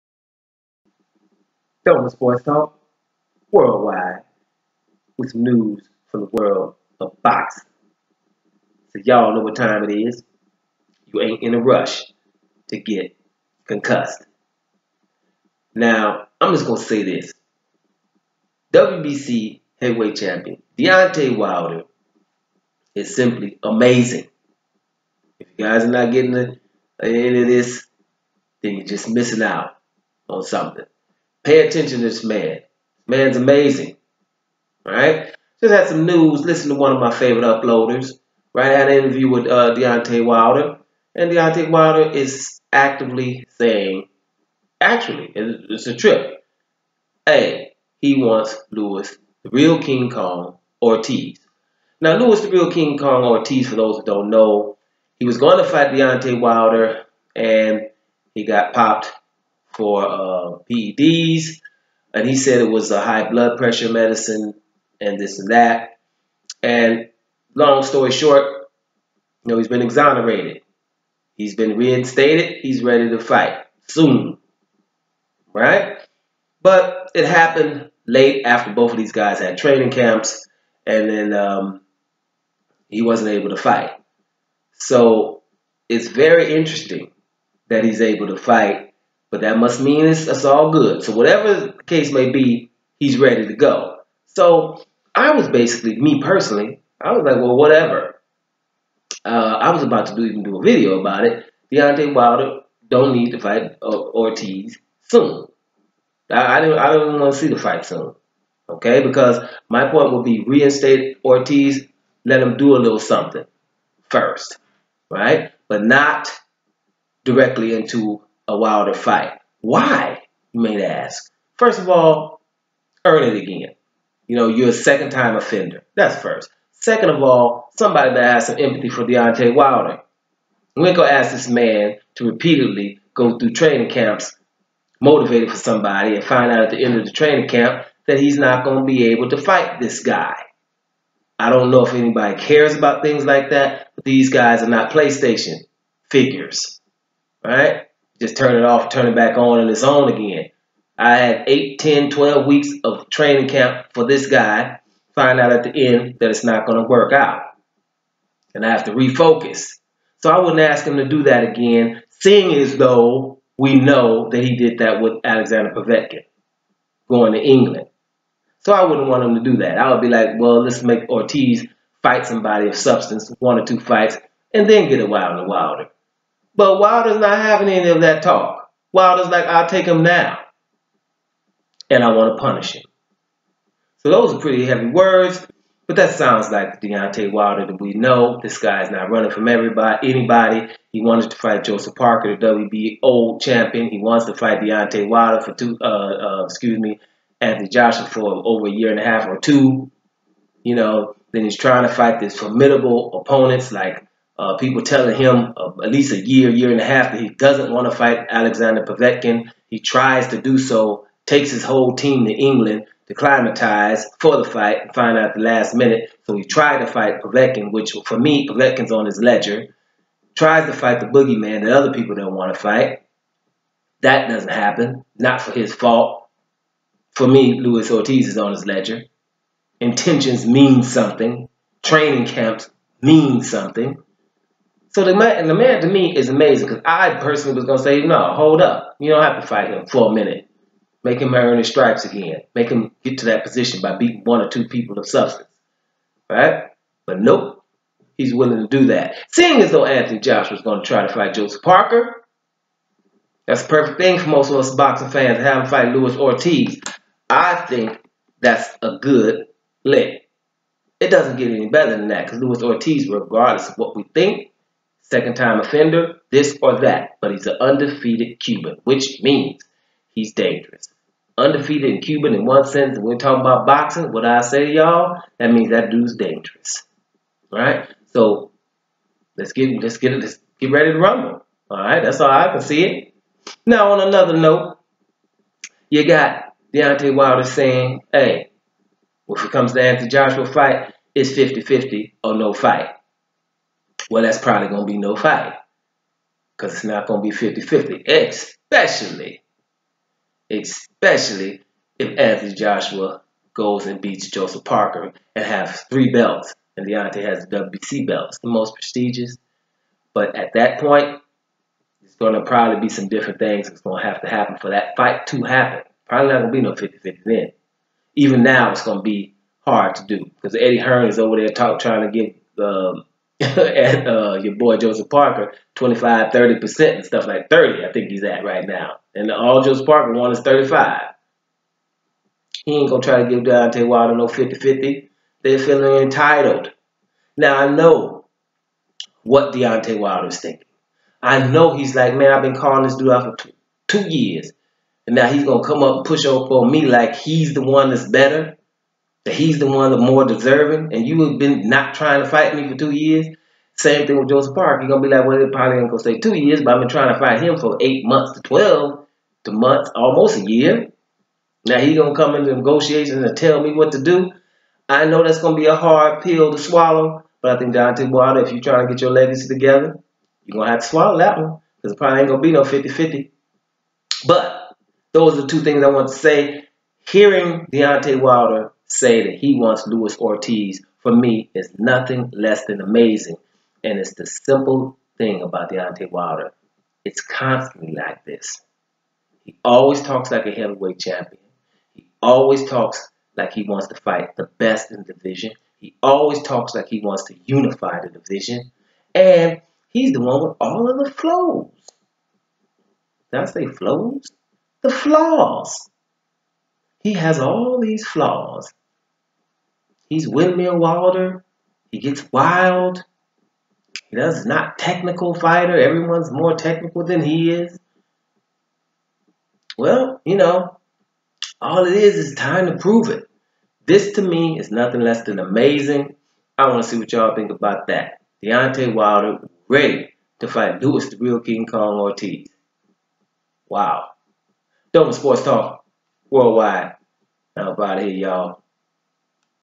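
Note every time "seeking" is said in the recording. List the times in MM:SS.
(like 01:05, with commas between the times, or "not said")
not said.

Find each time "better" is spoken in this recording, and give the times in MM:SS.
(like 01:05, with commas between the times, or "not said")
04:21, 05:48.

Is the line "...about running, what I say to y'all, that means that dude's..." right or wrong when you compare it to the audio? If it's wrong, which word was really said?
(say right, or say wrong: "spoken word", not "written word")
wrong: "boxing", not "running".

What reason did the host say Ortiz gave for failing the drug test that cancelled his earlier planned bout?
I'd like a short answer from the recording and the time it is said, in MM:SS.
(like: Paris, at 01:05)
High blood pressure medicine, at 01:03.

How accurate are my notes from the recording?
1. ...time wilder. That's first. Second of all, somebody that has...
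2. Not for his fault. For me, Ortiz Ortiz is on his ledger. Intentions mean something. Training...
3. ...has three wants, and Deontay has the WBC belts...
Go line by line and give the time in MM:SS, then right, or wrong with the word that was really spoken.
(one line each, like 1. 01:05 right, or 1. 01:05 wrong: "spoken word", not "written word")
1. 02:05 wrong: "offender", not "wilder"
2. 03:45 wrong: "Luis", not "Ortiz"
3. 05:05 wrong: "belts", not "wants".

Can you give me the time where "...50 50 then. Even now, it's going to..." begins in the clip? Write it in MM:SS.
05:16.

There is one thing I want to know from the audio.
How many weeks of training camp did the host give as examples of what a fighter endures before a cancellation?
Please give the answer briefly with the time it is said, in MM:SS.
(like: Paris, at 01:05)
8, 10, 12, at 02:31.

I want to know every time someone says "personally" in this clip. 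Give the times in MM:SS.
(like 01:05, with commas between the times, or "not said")
01:36, 03:57.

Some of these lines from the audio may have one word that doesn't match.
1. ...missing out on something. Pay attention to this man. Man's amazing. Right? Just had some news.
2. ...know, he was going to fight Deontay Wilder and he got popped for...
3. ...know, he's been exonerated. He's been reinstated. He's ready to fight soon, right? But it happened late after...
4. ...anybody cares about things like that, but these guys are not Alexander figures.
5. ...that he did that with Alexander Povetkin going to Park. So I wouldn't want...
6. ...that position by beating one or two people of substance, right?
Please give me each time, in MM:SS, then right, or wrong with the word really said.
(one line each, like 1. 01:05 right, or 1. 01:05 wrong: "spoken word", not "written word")
1. 00:29 right
2. 00:54 right
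3. 01:09 right
4. 02:21 wrong: "PlayStation", not "Alexander"
5. 02:44 wrong: "England", not "Park"
6. 04:03 right.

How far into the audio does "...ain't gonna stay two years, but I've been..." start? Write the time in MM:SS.
05:55.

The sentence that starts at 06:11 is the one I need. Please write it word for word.
Because it probably ain't gonna be no 50-50.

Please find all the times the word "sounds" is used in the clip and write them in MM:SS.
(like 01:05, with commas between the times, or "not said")
03:06.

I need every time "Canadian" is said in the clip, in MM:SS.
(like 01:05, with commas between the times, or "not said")
not said.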